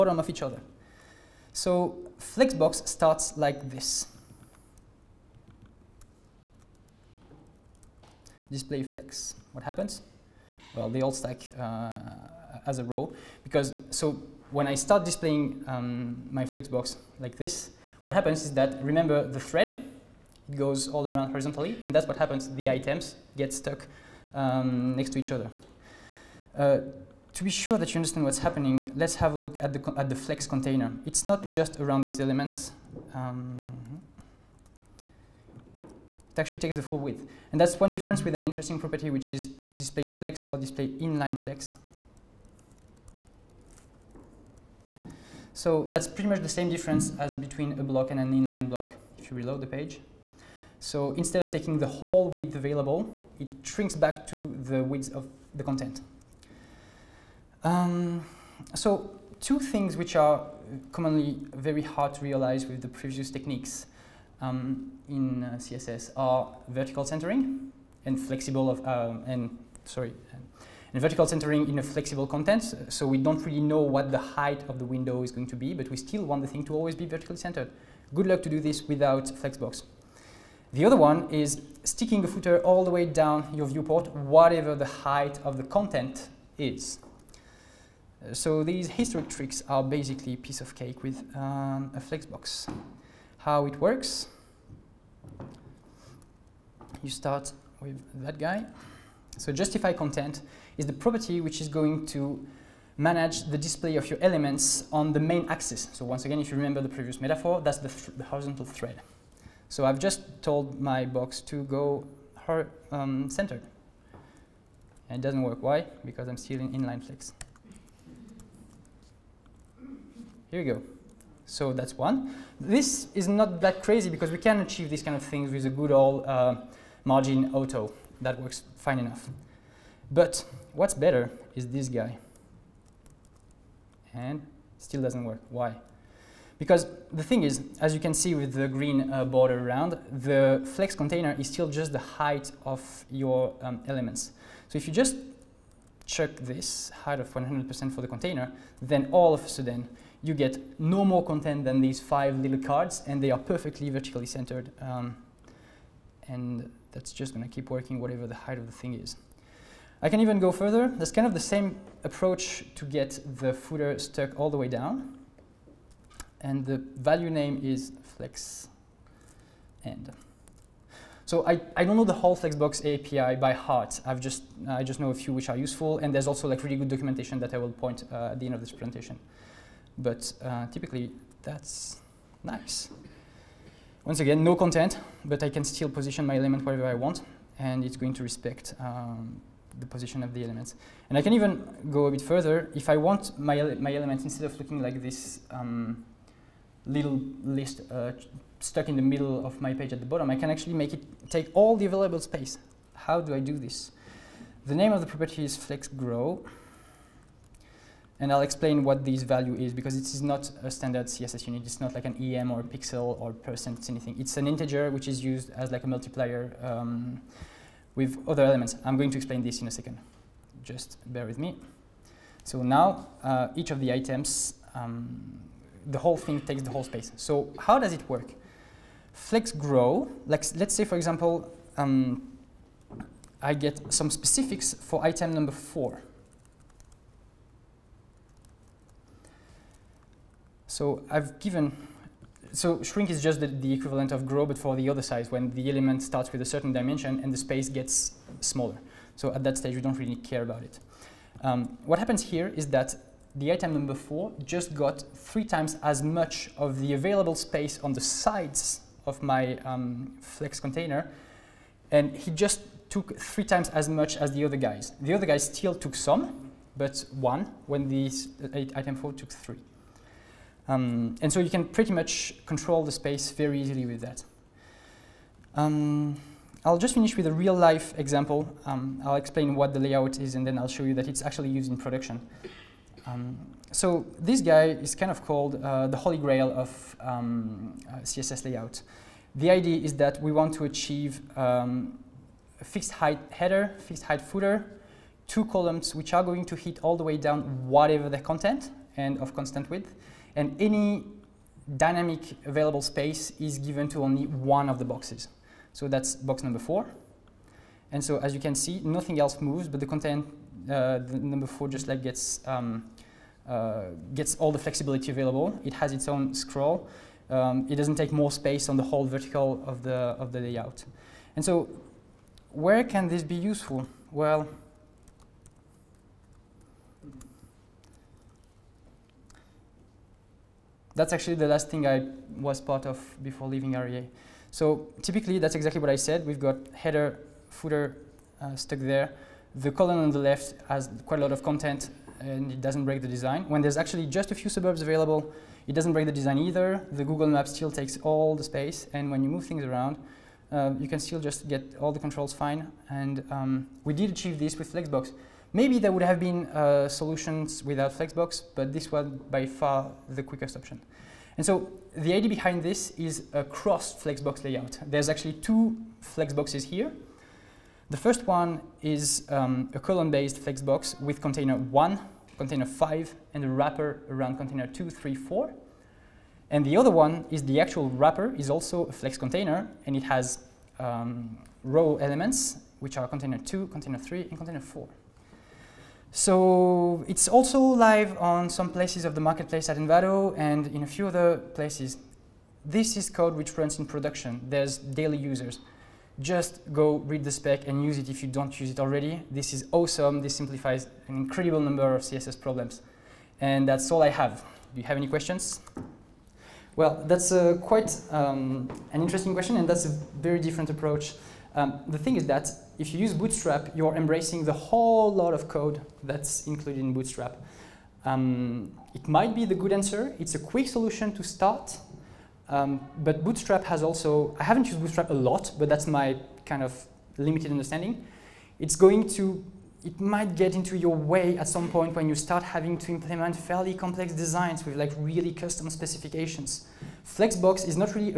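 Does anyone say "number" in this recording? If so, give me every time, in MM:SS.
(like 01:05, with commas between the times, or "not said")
03:55, 04:13, 05:06, 05:11, 06:41.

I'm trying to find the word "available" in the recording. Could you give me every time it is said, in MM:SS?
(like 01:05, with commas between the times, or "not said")
00:52, 03:21, 04:16, 05:02, 05:15, 05:44.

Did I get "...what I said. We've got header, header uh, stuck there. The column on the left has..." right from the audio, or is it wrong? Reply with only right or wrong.
wrong.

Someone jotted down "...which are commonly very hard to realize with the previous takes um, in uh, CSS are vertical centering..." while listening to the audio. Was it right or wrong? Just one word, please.
wrong.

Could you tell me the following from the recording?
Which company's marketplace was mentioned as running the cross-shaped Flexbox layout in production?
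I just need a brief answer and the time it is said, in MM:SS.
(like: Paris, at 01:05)
Envato, at 06:29.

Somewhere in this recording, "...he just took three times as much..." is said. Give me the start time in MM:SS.
04:22.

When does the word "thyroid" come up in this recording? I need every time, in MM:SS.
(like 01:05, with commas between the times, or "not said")
not said.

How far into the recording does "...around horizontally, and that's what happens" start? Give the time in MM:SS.
00:21.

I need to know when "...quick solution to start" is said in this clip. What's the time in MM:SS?
07:00.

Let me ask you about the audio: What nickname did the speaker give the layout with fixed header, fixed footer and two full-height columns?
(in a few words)
the holy grail.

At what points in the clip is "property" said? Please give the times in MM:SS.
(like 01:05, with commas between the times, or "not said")
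00:38, 01:40, 03:25.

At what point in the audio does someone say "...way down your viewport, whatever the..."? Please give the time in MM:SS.
01:22.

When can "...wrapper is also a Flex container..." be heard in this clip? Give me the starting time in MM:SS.
06:17.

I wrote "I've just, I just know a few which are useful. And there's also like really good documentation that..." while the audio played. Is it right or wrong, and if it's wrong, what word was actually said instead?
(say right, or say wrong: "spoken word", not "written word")
right.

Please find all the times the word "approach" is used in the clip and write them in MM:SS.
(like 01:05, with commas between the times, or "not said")
02:42, 06:50.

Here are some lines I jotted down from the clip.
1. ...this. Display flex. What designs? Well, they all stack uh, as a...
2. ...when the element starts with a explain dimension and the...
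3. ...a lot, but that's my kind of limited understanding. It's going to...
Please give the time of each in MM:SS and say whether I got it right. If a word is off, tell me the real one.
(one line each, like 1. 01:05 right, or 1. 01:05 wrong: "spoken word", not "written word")
1. 00:03 wrong: "happens", not "designs"
2. 04:05 wrong: "certain", not "explain"
3. 07:05 right.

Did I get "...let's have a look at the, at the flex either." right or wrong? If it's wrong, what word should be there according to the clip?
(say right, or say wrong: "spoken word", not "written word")
wrong: "container", not "either".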